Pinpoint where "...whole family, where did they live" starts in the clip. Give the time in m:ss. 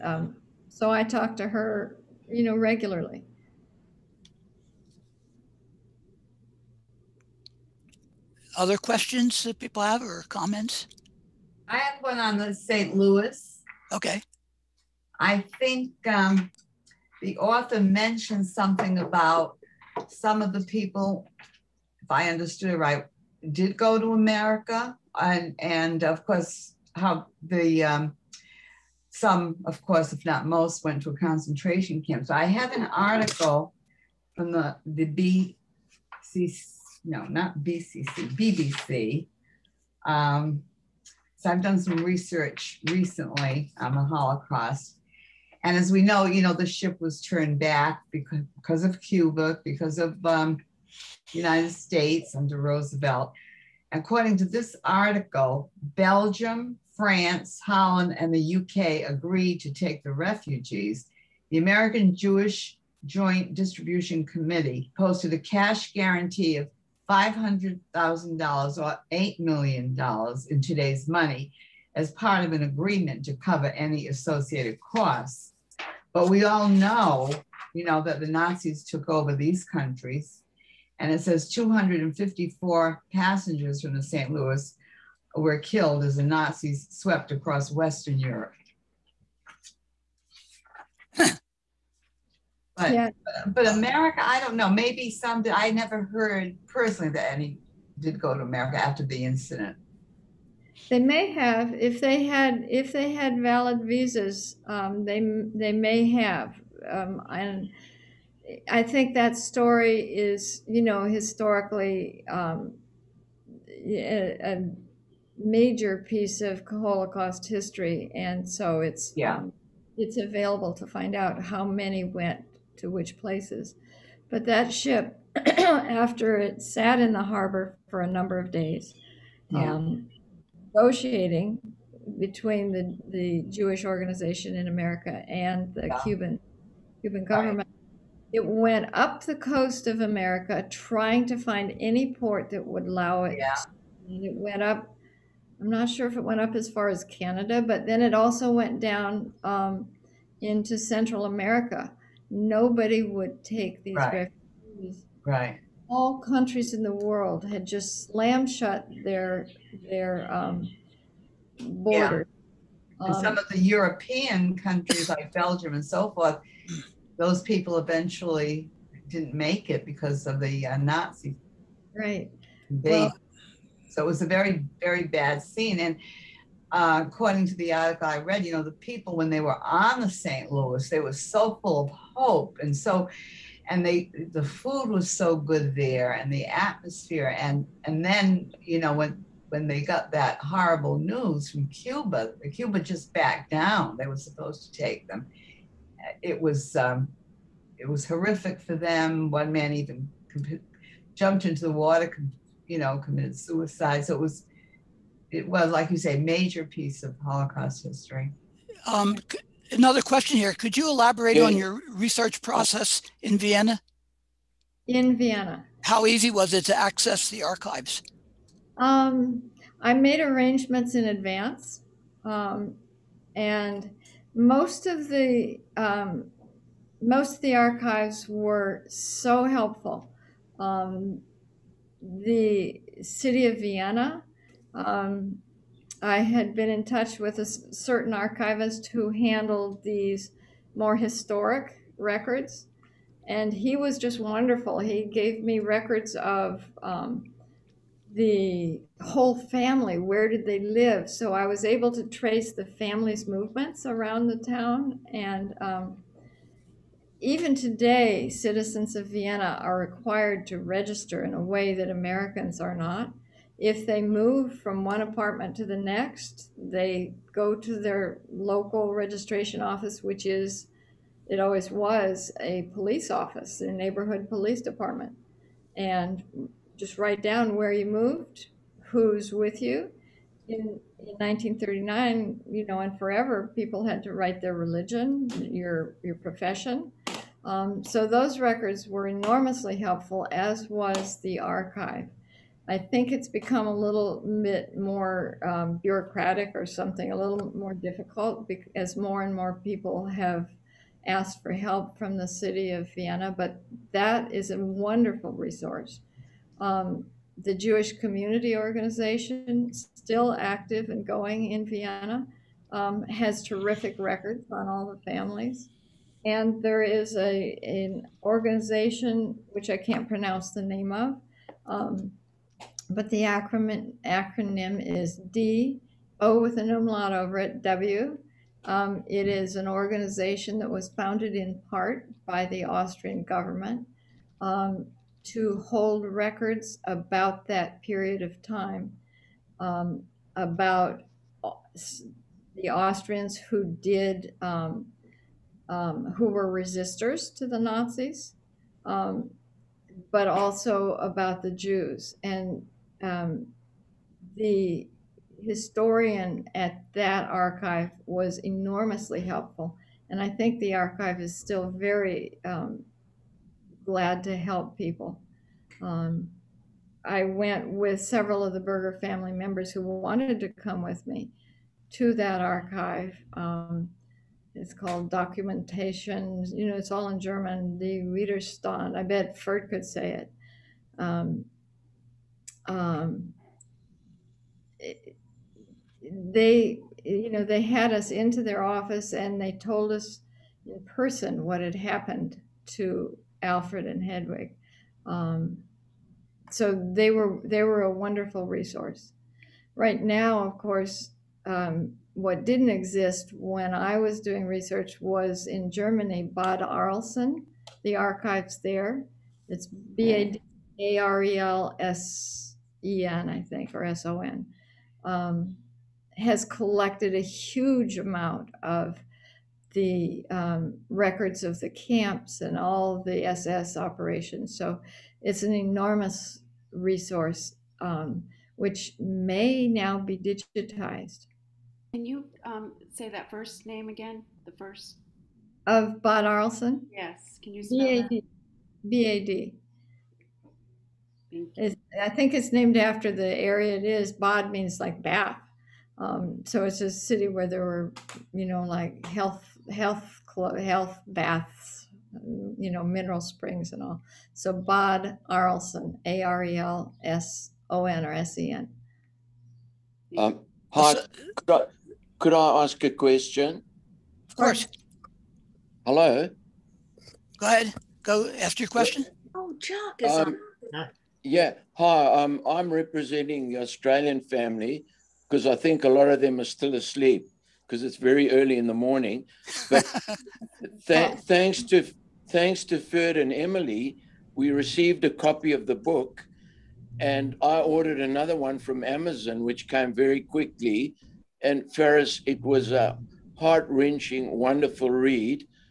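4:09.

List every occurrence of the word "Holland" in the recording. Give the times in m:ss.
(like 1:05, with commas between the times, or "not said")
0:57.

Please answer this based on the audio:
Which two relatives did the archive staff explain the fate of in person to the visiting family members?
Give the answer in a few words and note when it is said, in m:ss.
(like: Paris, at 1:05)
Alfred and Hedwig, at 6:33.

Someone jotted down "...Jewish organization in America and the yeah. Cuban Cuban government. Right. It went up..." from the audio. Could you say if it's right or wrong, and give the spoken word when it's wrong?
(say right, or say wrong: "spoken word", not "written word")
right.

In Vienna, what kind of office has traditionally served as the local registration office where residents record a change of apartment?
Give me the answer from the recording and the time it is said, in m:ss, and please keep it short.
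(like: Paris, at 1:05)
a police office, at 4:32.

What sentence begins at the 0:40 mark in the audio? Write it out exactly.
Um, so I've done some research recently on the Holocaust.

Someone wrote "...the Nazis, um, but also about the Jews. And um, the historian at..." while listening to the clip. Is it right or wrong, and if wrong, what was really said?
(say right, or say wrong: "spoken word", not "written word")
right.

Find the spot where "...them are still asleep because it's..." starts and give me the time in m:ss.
7:56.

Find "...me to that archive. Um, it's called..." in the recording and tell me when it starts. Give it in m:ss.
6:11.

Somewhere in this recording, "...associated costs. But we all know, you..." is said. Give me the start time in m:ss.
1:14.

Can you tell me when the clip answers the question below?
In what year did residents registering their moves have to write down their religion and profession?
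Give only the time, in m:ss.
4:41.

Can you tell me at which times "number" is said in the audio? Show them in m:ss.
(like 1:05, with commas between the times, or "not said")
2:08.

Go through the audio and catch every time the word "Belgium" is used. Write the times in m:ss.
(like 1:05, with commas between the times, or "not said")
0:55, 2:45.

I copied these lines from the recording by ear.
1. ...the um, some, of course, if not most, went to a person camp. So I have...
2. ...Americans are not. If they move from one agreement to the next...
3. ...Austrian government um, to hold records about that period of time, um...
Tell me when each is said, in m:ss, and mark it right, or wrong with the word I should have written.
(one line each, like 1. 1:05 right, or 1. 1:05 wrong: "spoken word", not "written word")
1. 0:27 wrong: "concentration", not "person"
2. 4:21 wrong: "apartment", not "agreement"
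3. 5:32 right.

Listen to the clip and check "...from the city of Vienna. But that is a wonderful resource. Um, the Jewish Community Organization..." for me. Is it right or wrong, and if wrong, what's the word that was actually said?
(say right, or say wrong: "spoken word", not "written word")
right.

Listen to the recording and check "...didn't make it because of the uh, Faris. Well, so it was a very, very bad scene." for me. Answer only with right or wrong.
wrong.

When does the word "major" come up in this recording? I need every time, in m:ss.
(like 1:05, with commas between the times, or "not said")
1:55, 3:26.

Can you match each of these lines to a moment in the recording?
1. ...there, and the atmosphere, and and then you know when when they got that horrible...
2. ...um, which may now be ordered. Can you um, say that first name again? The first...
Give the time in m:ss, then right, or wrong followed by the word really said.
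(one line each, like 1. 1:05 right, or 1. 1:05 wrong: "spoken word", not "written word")
1. 3:05 right
2. 7:07 wrong: "digitized", not "ordered".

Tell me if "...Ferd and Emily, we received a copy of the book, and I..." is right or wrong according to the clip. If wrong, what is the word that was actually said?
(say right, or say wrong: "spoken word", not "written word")
right.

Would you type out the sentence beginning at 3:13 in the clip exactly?
They were supposed to take them.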